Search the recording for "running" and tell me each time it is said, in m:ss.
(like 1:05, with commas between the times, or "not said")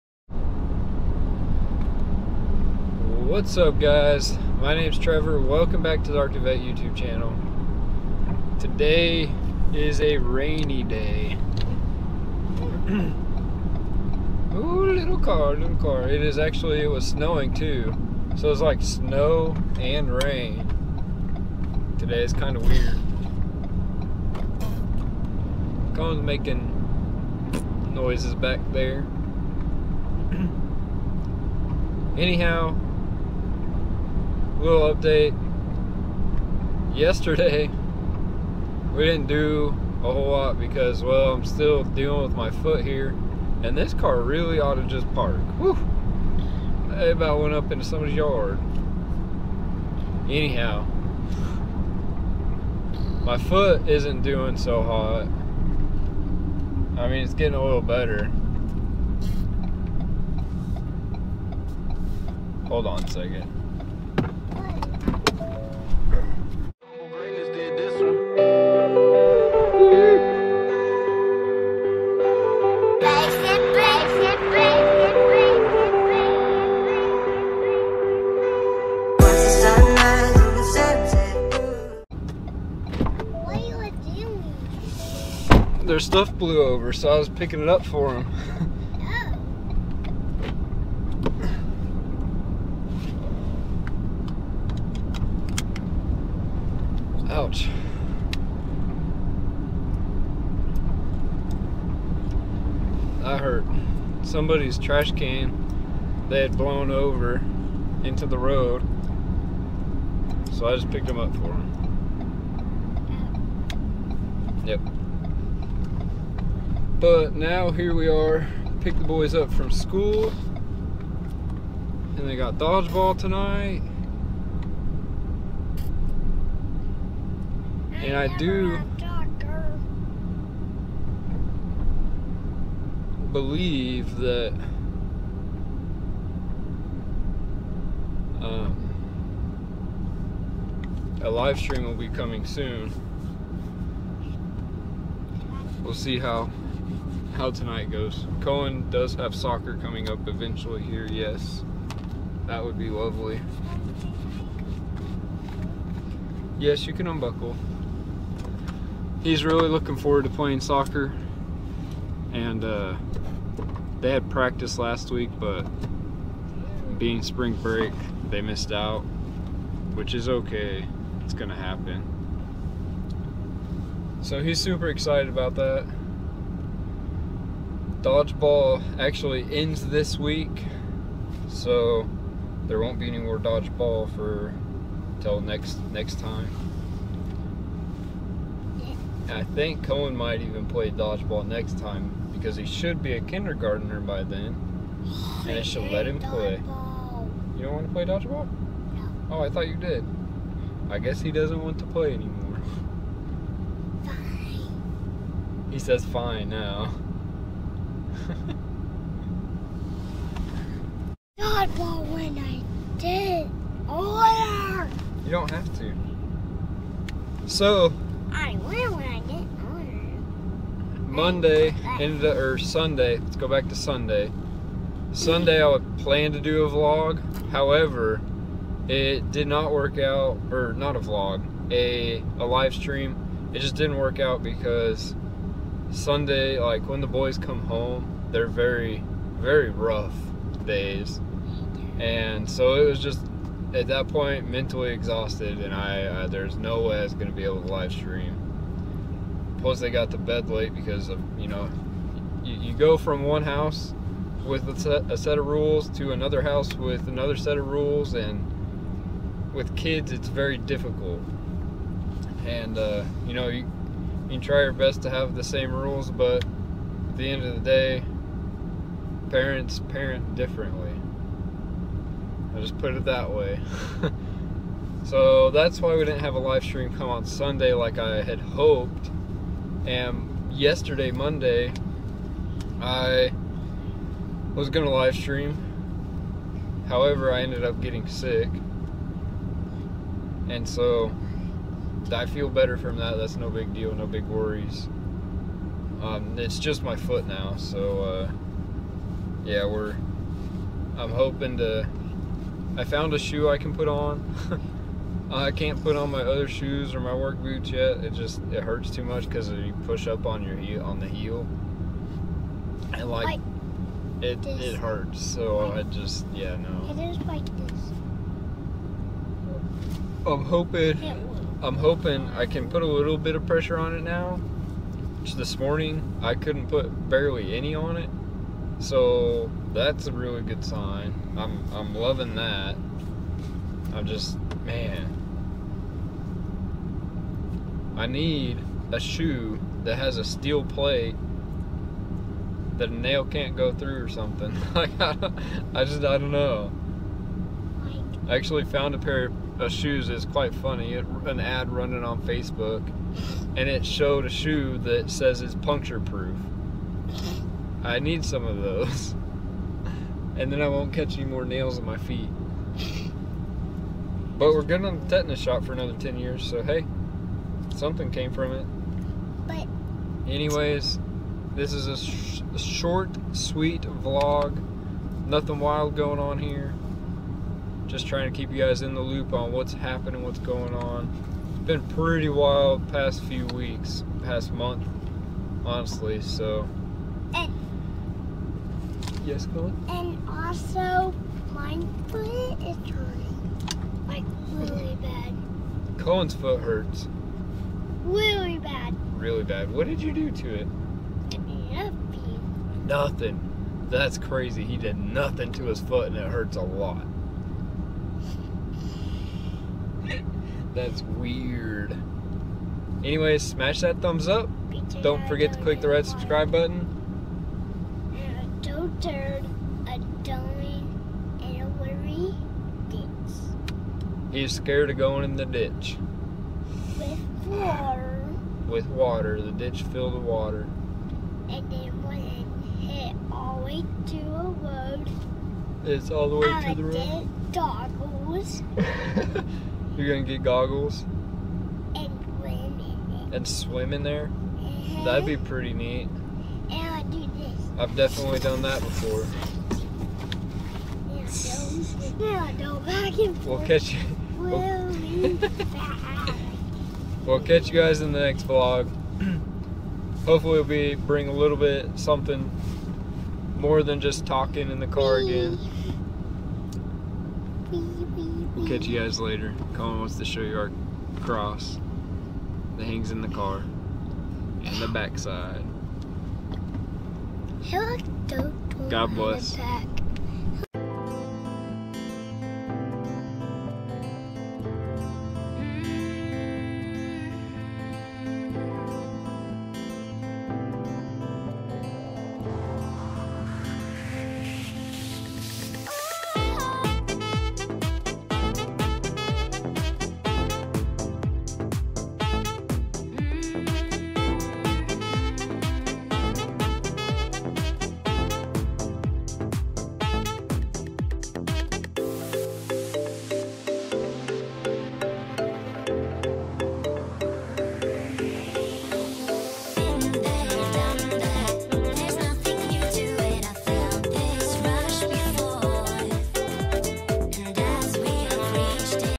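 5:51.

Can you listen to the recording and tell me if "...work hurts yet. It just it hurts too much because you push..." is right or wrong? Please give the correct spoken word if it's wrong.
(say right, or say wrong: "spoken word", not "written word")
wrong: "boots", not "hurts".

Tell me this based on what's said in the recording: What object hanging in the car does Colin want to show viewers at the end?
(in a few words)
Cross.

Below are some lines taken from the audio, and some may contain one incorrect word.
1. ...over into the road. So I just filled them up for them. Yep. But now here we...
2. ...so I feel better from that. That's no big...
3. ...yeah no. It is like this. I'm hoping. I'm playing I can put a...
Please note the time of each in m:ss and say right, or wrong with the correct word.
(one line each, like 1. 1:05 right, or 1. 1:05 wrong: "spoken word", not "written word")
1. 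1:46 wrong: "picked", not "filled"
2. 4:50 right
3. 5:16 wrong: "hoping", not "playing".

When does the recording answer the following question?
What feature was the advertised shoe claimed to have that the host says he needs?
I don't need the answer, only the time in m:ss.
5:55.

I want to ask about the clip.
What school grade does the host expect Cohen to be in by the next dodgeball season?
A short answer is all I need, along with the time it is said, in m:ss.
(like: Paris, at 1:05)
Kindergartner, at 3:13.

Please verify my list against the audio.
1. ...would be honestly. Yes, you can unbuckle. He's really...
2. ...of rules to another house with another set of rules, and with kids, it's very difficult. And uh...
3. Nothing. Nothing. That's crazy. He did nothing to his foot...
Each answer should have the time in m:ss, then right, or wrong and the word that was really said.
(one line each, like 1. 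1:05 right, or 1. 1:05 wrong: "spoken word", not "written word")
1. 2:32 wrong: "lovely", not "honestly"
2. 4:15 right
3. 6:41 right.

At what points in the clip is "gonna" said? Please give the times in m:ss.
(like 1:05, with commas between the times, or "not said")
2:51, 4:07, 7:20.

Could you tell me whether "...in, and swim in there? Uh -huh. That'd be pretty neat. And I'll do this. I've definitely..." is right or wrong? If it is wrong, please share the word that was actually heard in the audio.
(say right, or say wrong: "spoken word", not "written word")
right.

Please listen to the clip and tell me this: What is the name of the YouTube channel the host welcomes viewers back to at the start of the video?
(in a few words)
Archivet.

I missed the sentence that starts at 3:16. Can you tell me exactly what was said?
play you don't want to play dodgeball no.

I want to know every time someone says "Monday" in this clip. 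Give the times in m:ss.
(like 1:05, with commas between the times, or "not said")
3:41, 4:41.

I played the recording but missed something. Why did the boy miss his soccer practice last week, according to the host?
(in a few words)
Spring break.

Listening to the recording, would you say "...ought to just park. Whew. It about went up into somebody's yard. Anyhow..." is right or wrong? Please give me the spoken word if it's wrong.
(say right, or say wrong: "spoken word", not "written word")
right.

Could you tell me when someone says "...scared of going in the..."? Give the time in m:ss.
7:04.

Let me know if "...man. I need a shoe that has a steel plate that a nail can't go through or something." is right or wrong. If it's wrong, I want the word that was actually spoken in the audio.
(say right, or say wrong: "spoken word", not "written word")
right.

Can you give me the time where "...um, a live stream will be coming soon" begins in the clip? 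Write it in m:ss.
2:18.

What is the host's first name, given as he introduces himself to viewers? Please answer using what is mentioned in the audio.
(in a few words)
Trevor.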